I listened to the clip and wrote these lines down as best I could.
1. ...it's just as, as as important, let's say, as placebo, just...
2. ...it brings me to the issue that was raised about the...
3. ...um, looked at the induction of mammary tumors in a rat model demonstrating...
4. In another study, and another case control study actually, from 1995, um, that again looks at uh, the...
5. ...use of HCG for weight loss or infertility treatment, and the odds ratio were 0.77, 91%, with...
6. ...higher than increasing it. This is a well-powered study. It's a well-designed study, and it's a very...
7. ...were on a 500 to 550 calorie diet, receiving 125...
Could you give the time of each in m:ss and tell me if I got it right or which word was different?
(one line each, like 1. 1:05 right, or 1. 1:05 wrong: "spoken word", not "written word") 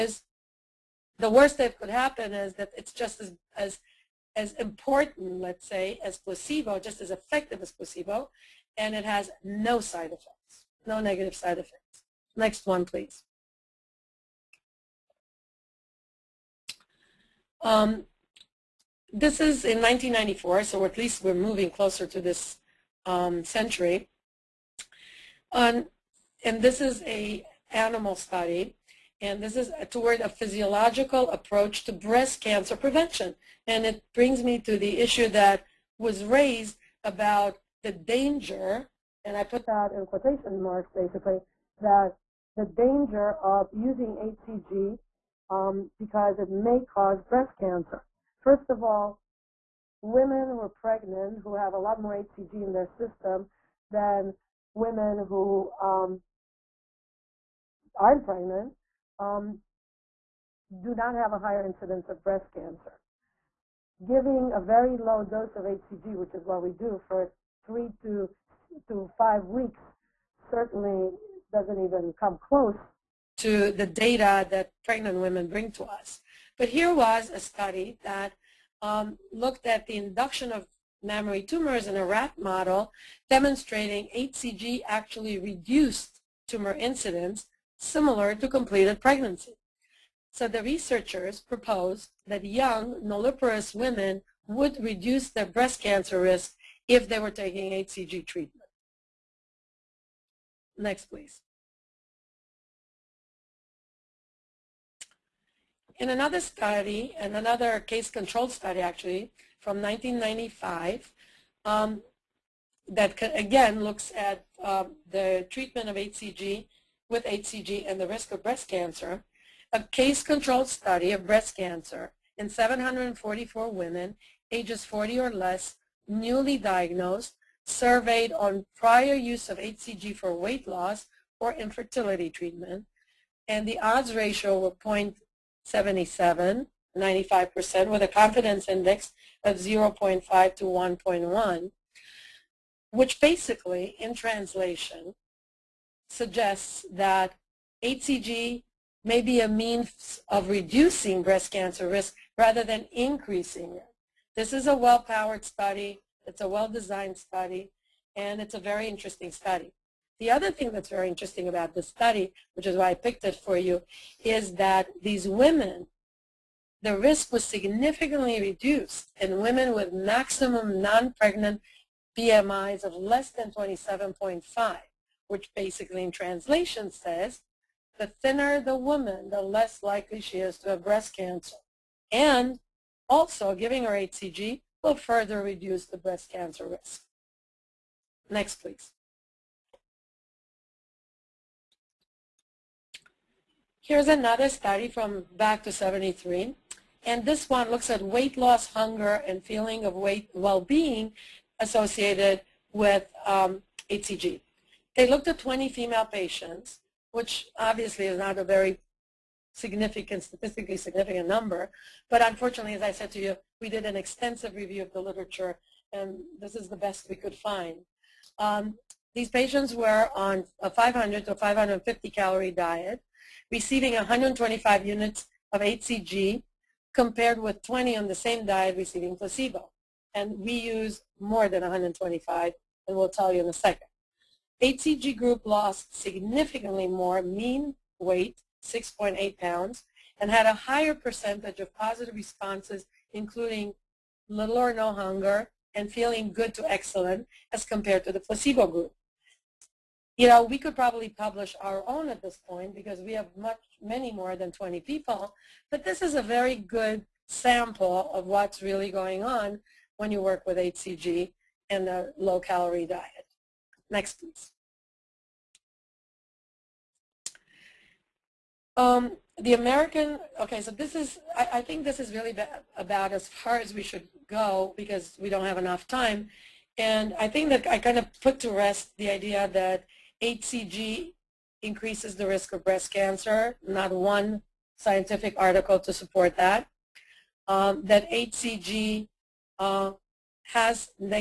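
1. 0:02 right
2. 0:33 right
3. 1:18 right
4. 1:45 right
5. 2:09 wrong: "95", not "91"
6. 2:32 wrong: "rather", not "higher"
7. 3:39 right.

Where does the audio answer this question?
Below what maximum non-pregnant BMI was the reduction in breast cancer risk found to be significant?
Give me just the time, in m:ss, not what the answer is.
2:53.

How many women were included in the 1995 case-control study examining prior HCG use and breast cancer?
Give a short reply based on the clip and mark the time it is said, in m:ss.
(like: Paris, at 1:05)
744, at 2:02.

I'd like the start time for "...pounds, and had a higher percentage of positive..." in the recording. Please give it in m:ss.
3:59.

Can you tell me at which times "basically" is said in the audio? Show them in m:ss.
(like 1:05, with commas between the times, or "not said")
0:40, 2:23, 2:55.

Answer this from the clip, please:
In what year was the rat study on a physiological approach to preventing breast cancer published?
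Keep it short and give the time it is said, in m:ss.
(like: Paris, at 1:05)
1994, at 0:19.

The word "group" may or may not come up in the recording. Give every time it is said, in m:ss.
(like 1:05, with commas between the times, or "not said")
3:55, 4:08.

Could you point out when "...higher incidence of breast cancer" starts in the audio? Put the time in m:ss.
1:01.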